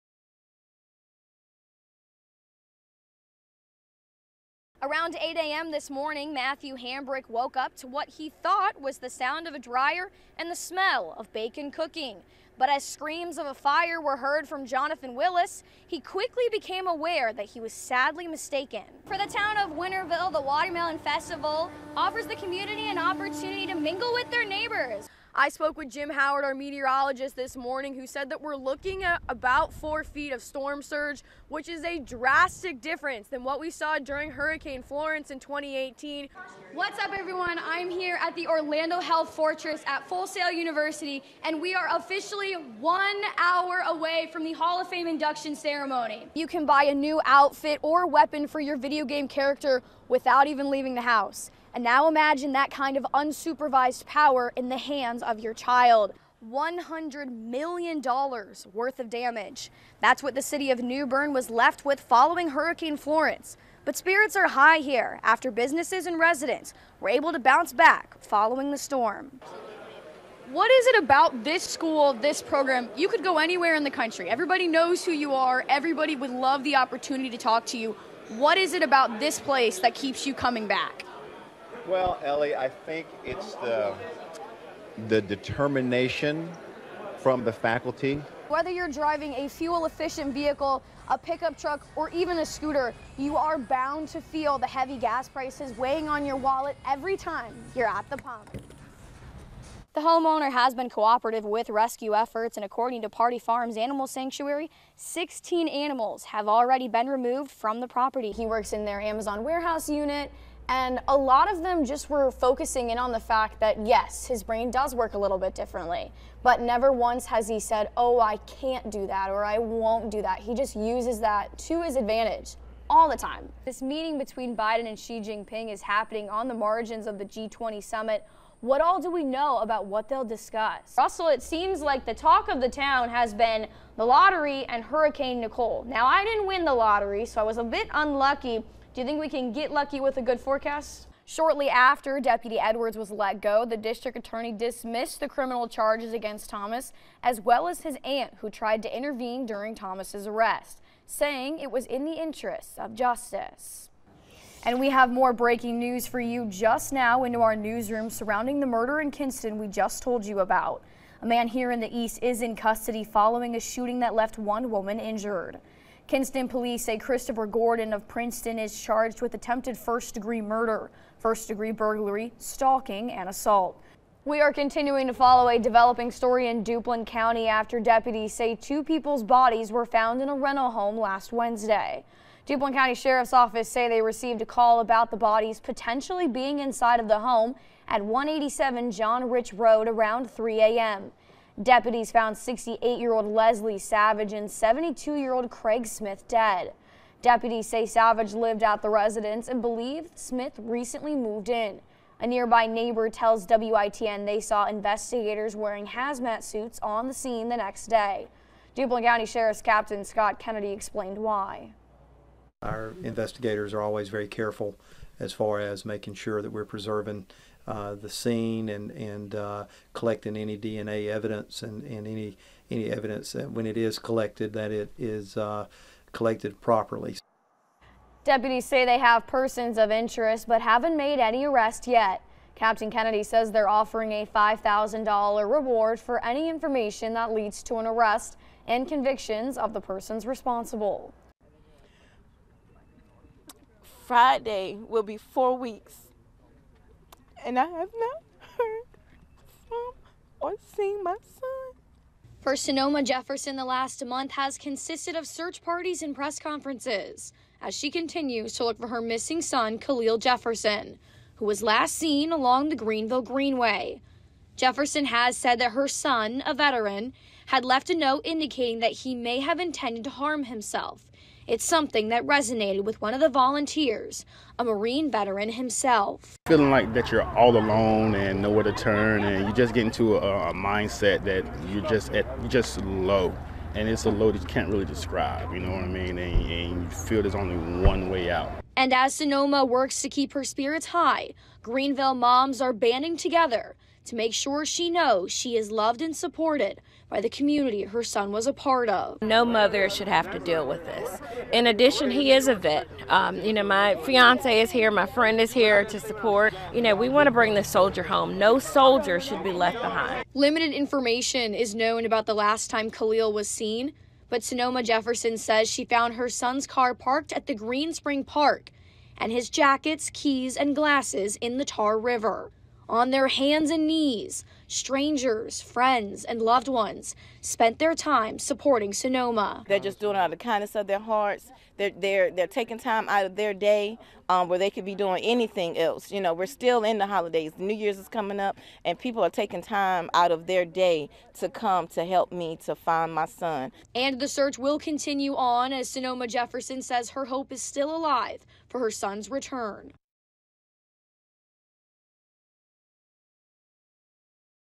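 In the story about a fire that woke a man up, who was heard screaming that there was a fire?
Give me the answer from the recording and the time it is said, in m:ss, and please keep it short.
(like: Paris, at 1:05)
Jonathan Willis, at 0:14.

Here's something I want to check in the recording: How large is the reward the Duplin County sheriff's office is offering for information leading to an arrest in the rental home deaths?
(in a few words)
$5,000.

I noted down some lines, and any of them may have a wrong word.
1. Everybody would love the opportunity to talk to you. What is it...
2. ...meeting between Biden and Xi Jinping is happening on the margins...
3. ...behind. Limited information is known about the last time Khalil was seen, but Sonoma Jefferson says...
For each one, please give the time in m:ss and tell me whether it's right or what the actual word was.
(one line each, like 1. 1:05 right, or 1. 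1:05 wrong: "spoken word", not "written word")
1. 1:15 right
2. 2:03 right
3. 5:09 right.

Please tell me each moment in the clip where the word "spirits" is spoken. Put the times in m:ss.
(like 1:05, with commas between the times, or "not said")
1:03, 4:50.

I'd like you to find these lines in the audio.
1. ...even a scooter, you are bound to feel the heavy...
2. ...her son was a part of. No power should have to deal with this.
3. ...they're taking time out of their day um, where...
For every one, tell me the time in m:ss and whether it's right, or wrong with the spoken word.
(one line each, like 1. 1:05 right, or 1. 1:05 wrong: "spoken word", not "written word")
1. 1:32 right
2. 4:57 wrong: "mother", not "power"
3. 5:32 right.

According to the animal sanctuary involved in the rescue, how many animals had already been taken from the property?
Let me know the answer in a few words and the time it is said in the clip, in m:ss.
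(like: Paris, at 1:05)
16, at 1:44.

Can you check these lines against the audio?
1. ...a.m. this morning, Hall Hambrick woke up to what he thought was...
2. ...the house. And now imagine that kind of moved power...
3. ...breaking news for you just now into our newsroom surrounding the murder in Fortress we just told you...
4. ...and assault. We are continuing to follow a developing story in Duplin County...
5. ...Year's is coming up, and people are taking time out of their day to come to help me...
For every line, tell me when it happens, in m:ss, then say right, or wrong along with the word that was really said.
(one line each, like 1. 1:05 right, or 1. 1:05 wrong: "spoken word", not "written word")
1. 0:05 wrong: "Matthew", not "Hall"
2. 0:50 wrong: "unsupervised", not "moved"
3. 2:35 wrong: "Kinston", not "Fortress"
4. 2:53 right
5. 5:37 right.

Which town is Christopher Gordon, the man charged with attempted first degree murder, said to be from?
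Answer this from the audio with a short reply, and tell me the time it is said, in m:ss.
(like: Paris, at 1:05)
Princeton, at 2:48.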